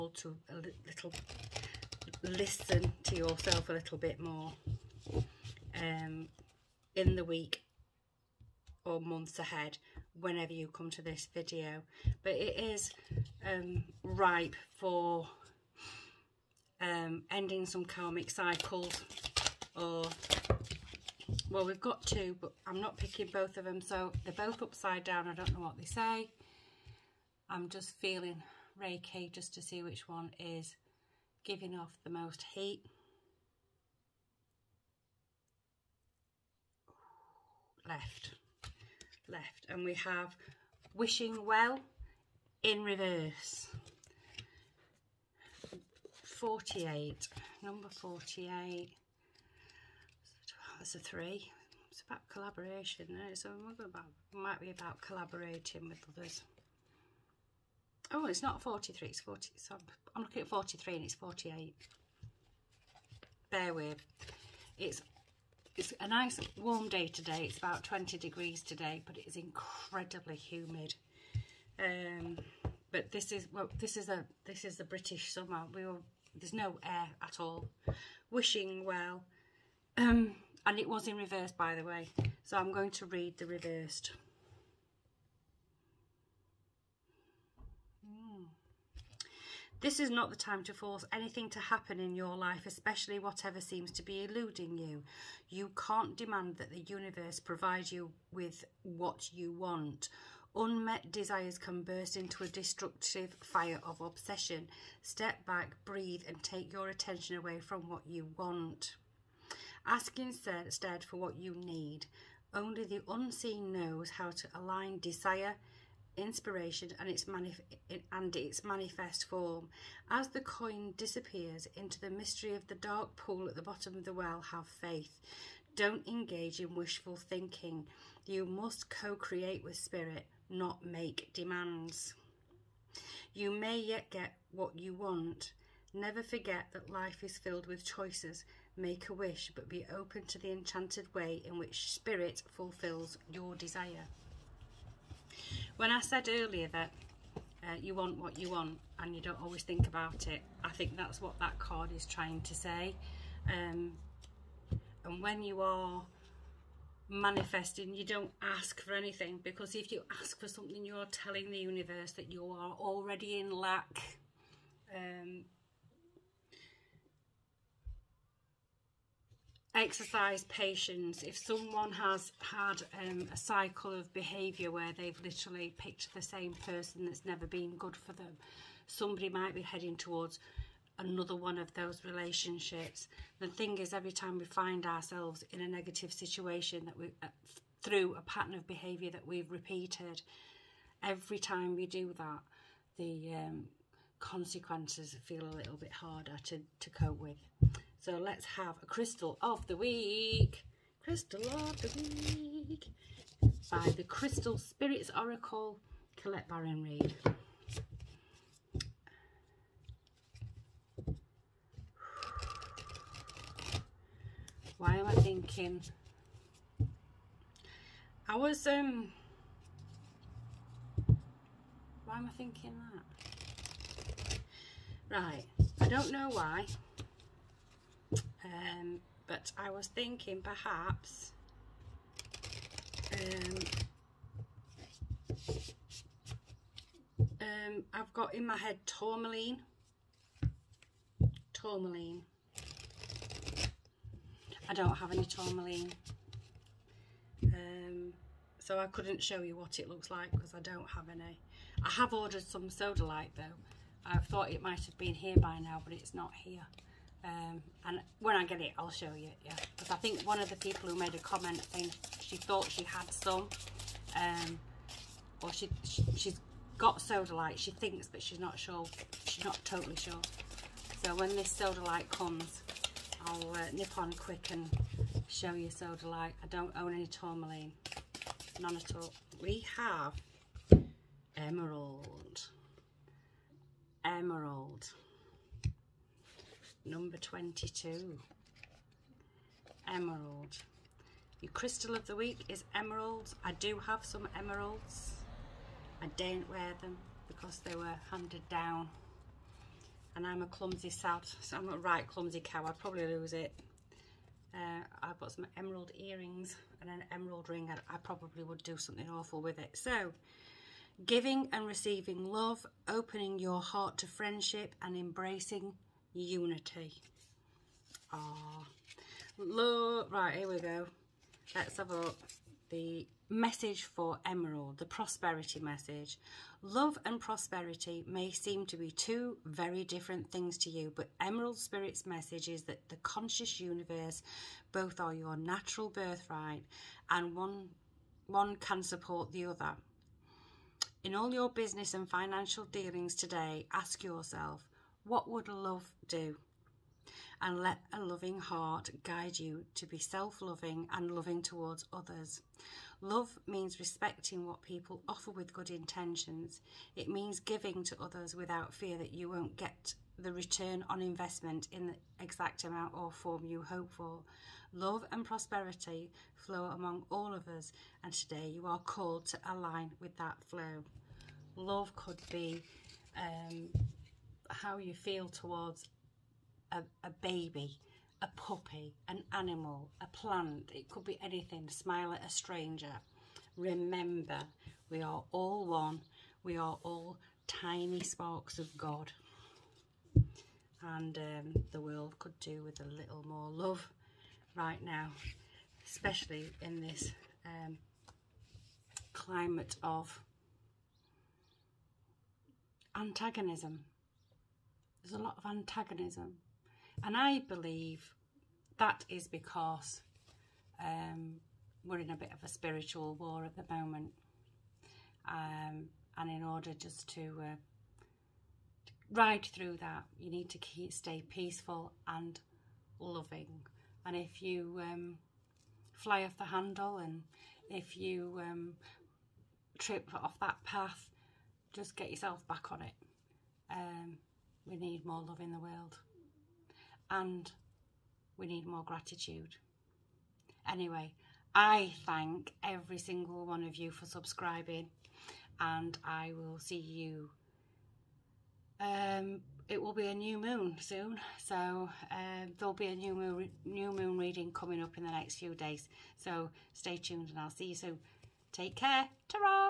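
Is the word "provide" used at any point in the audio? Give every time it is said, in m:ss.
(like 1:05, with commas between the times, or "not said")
1:37.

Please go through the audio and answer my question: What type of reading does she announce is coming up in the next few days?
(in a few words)
New moon reading.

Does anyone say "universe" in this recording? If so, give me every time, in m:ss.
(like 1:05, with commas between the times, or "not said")
1:36, 2:41, 5:33.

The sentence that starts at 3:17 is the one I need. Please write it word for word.
So let's have a crystal of the week.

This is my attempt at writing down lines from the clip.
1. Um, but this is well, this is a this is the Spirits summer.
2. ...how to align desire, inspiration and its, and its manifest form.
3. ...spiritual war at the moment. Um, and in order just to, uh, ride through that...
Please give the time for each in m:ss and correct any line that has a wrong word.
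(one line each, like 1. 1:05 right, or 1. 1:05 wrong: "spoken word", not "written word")
1. 1:11 wrong: "British", not "Spirits"
2. 1:54 right
3. 6:52 right.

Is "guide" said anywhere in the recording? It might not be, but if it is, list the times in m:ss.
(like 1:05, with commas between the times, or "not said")
5:49.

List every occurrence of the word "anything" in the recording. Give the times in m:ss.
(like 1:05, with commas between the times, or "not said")
1:31, 2:38, 6:21.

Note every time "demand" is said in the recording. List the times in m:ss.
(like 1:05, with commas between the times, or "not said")
1:36, 2:11.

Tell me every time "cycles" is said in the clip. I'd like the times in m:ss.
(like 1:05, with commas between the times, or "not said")
0:18, 2:53.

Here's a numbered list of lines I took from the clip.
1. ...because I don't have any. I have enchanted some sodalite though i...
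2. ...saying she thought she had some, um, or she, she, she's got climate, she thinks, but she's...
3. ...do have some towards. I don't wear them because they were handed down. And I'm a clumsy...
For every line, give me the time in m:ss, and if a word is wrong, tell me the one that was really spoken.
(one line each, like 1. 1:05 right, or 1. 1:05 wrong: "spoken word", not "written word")
1. 4:10 wrong: "ordered", not "enchanted"
2. 4:21 wrong: "sodalite", not "climate"
3. 4:53 wrong: "emeralds", not "towards".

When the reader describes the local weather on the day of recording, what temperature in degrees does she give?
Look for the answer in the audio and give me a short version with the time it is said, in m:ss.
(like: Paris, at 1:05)
20, at 1:07.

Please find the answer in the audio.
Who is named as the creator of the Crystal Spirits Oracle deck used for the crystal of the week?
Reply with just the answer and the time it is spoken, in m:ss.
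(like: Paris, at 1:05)
Colette Baron Reid, at 3:26.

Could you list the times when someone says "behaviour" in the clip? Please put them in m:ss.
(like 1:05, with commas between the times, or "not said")
2:54, 3:08.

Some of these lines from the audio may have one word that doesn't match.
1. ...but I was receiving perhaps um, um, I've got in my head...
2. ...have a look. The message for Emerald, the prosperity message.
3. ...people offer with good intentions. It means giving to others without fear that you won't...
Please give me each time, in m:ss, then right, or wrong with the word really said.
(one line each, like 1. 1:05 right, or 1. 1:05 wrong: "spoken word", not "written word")
1. 3:49 wrong: "thinking", not "receiving"
2. 5:21 right
3. 5:54 right.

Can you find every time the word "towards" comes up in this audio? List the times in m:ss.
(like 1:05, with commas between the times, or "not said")
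2:59, 5:51, 6:15.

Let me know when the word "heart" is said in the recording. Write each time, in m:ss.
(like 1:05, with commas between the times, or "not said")
5:13, 5:48.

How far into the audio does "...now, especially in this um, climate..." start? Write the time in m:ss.
6:34.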